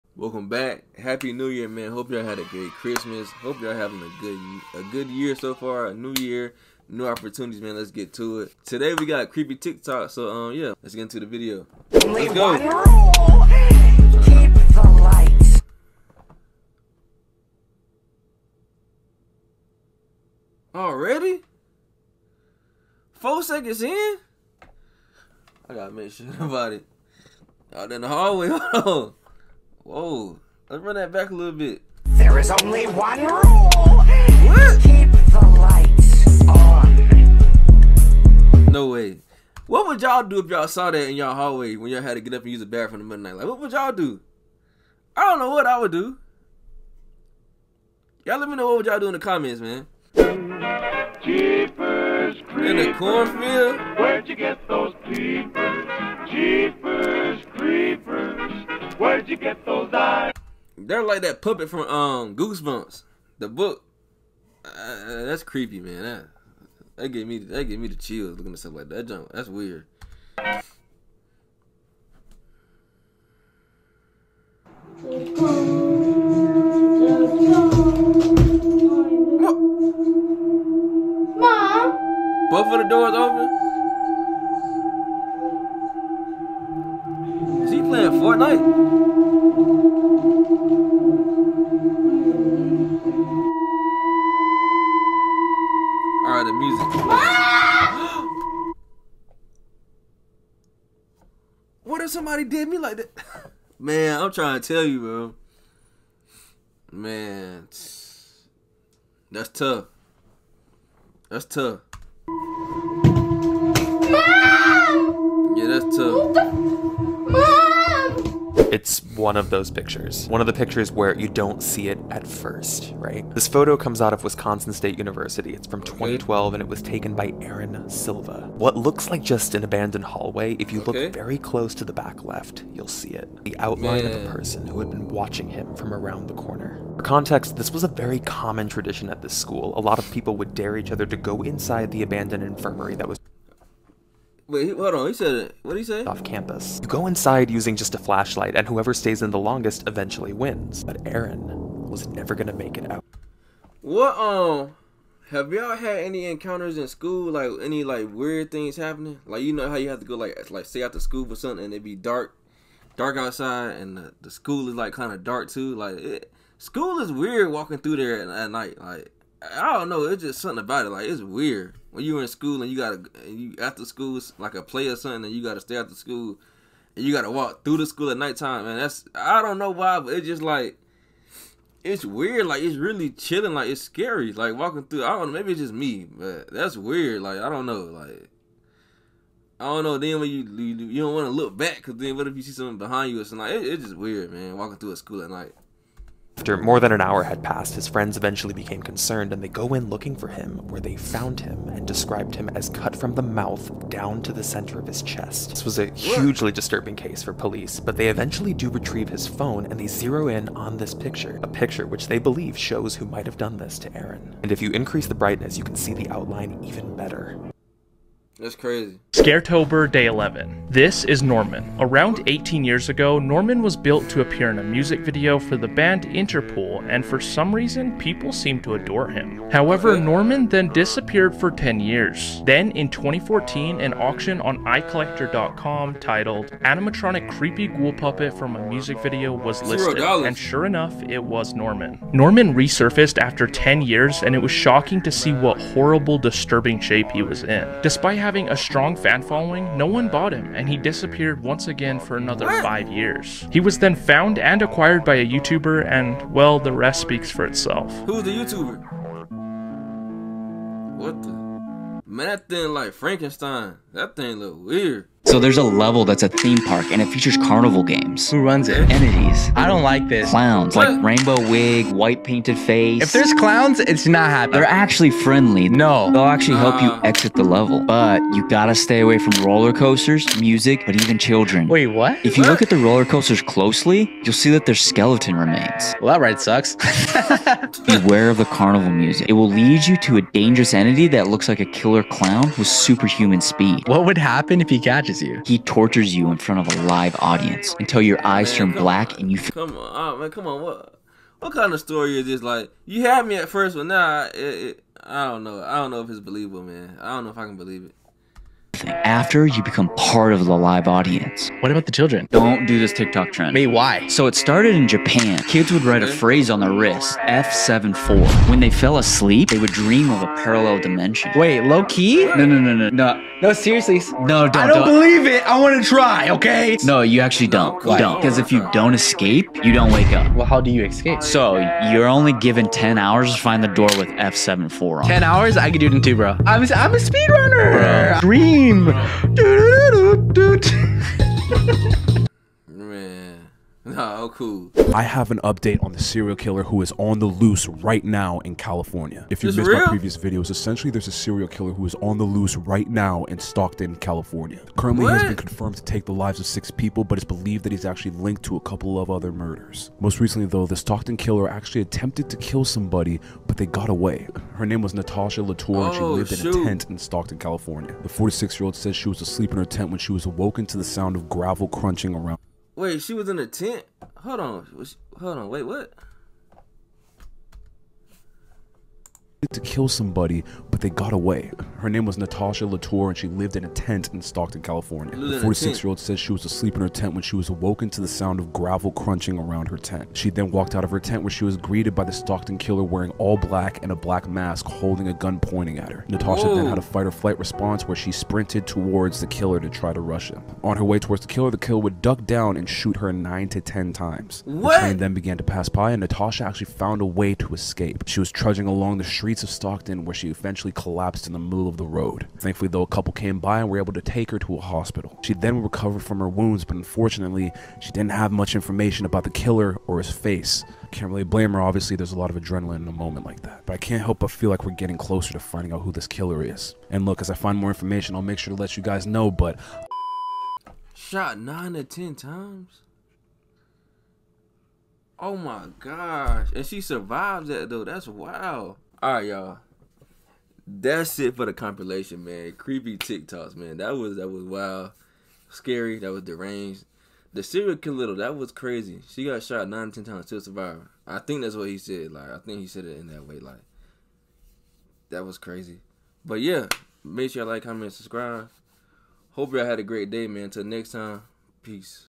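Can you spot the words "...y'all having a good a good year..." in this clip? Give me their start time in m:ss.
0:03.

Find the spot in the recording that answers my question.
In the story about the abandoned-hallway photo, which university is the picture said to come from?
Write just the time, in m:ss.
2:04.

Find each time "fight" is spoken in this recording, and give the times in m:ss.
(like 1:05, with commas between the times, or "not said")
6:36.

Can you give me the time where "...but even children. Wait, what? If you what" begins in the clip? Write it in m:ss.
4:40.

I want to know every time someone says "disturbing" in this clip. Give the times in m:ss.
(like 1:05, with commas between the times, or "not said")
3:26, 4:06.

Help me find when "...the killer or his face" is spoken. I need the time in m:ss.
6:59.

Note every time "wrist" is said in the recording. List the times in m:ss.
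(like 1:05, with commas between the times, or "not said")
5:16.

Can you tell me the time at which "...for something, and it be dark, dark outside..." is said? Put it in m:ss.
2:41.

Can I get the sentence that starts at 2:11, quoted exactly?
look very close to the back left, you'll see it.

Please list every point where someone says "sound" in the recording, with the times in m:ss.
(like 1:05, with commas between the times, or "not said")
6:10, 6:28.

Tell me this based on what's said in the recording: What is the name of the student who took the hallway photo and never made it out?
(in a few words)
Aaron Silva.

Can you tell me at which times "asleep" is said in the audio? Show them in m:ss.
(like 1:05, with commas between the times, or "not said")
5:18, 6:09, 6:26.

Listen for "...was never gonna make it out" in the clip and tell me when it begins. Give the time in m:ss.
2:31.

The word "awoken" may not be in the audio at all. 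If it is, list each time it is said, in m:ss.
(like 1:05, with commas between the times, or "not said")
6:10, 6:27.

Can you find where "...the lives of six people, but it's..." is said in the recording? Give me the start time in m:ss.
5:56.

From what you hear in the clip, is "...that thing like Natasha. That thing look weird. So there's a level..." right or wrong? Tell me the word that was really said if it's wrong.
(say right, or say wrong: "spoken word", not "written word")
wrong: "Frankenstein", not "Natasha".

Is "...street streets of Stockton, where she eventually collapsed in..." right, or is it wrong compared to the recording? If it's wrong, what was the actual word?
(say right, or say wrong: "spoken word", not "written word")
right.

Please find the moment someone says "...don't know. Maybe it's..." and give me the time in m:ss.
3:05.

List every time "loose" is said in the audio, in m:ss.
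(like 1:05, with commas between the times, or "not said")
5:47, 5:52.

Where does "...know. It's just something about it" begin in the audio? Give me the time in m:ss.
2:49.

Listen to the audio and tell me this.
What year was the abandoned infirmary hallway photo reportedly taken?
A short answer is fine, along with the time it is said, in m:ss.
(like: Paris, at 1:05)
2012, at 2:05.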